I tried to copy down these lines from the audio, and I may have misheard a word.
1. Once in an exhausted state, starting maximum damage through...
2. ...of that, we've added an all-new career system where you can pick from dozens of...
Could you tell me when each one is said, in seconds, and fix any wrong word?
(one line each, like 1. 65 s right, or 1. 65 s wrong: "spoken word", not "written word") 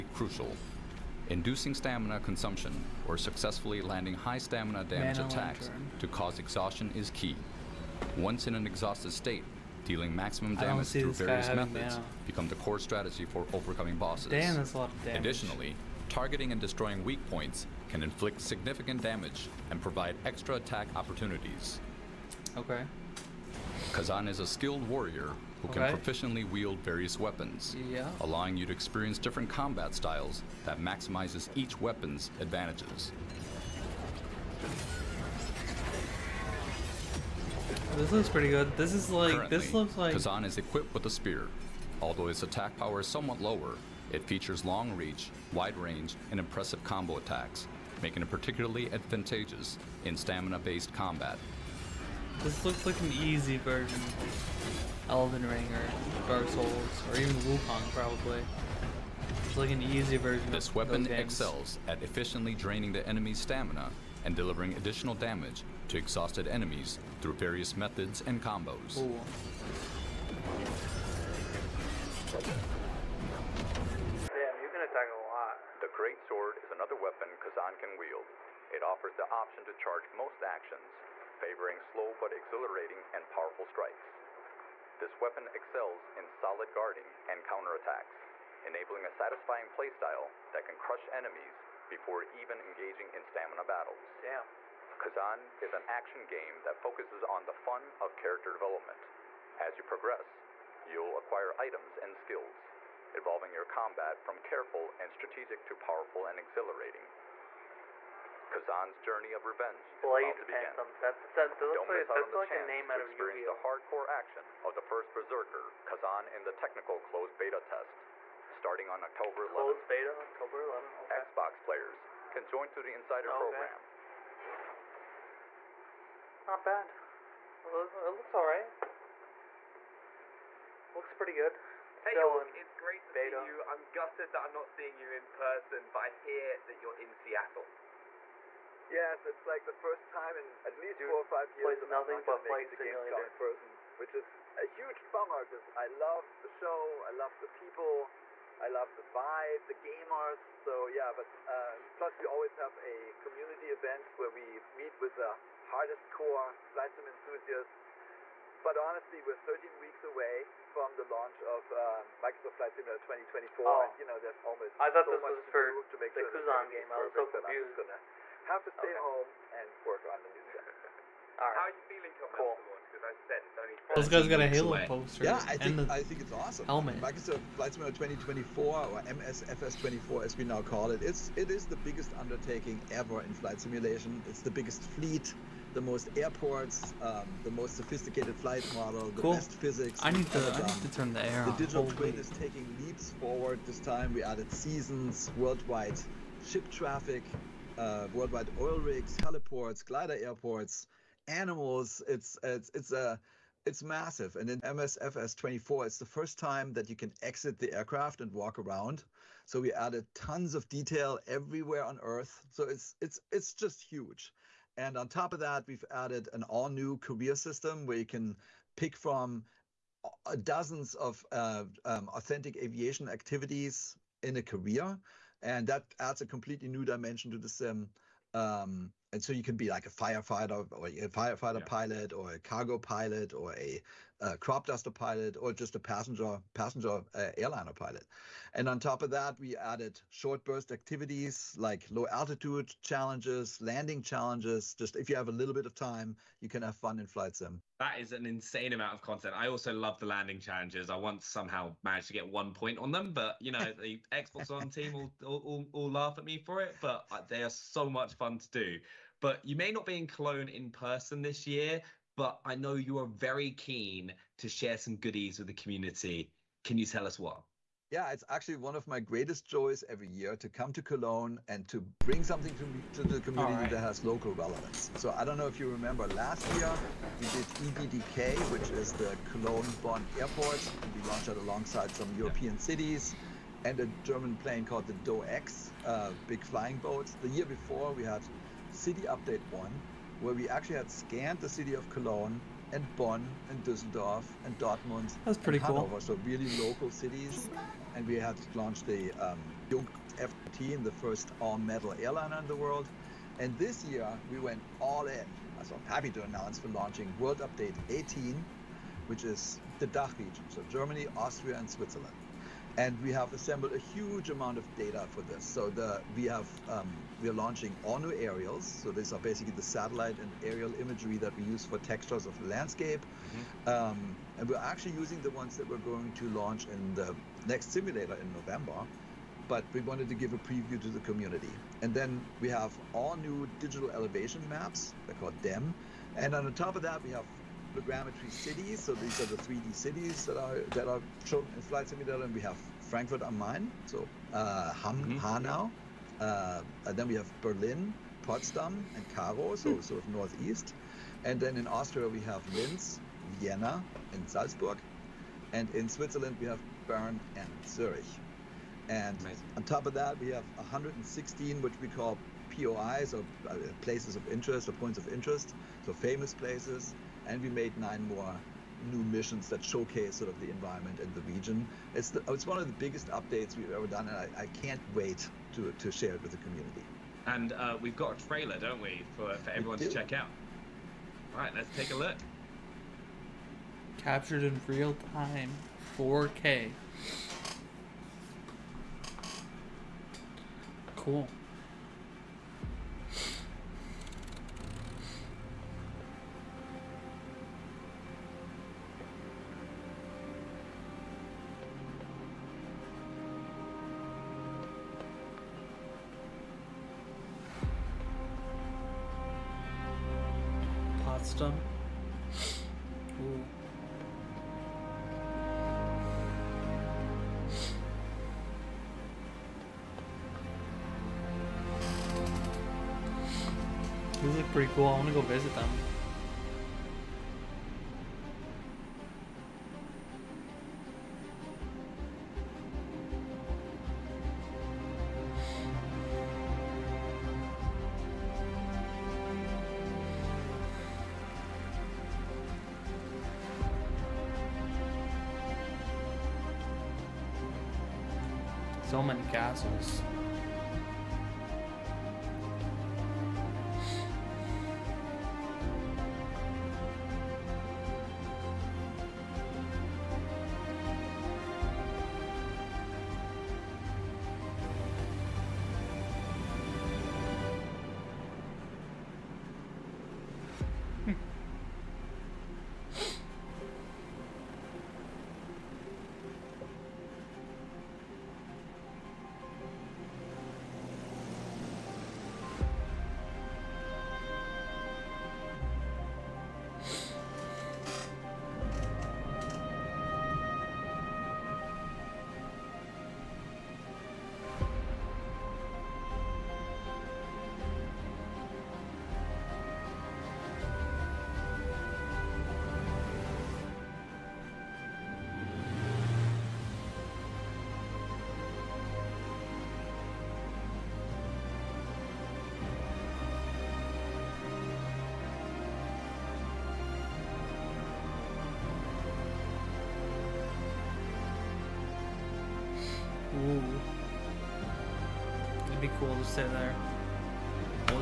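1. 8 s wrong: "dealing", not "starting"
2. 215 s right.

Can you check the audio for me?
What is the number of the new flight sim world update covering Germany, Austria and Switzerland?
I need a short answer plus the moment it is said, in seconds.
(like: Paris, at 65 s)
18, at 307 s.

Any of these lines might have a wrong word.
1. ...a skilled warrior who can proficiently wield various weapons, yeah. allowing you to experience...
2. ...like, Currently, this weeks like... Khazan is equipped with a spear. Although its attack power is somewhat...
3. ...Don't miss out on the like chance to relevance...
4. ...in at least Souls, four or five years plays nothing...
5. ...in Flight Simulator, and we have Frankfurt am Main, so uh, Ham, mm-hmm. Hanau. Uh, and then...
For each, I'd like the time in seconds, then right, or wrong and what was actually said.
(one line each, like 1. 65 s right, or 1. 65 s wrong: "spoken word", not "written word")
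1. 24 s right
2. 39 s wrong: "looks", not "weeks"
3. 111 s wrong: "experience", not "relevance"
4. 140 s wrong: "Dude", not "Souls"
5. 341 s right.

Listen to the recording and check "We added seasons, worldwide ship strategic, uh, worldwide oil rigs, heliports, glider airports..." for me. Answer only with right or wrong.
wrong.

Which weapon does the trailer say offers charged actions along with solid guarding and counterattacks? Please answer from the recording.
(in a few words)
Great Sword.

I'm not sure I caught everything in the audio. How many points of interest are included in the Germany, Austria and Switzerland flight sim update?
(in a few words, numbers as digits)
116.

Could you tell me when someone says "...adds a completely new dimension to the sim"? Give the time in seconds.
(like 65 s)
225 s.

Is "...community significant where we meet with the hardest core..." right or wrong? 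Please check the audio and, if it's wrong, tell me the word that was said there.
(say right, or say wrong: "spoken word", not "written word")
wrong: "event", not "significant".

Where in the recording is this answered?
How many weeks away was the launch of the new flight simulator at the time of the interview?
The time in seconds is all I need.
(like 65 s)
159 s.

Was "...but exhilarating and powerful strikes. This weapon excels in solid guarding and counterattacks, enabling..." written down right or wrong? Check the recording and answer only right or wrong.
right.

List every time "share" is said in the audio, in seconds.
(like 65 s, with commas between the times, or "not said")
264 s, 375 s.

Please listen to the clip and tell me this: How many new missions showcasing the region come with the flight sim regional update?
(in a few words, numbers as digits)
9.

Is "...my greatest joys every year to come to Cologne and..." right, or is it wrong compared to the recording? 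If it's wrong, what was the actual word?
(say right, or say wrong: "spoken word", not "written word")
right.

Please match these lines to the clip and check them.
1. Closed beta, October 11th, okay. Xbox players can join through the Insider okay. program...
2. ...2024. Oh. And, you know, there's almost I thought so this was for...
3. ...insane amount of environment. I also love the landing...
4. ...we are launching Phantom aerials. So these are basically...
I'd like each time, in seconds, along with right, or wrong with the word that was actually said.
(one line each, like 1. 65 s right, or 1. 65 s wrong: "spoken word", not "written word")
1. 119 s right
2. 163 s right
3. 248 s wrong: "content", not "environment"
4. 317 s wrong: "ONU", not "Phantom".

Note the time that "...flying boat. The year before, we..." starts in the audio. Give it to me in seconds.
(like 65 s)
286 s.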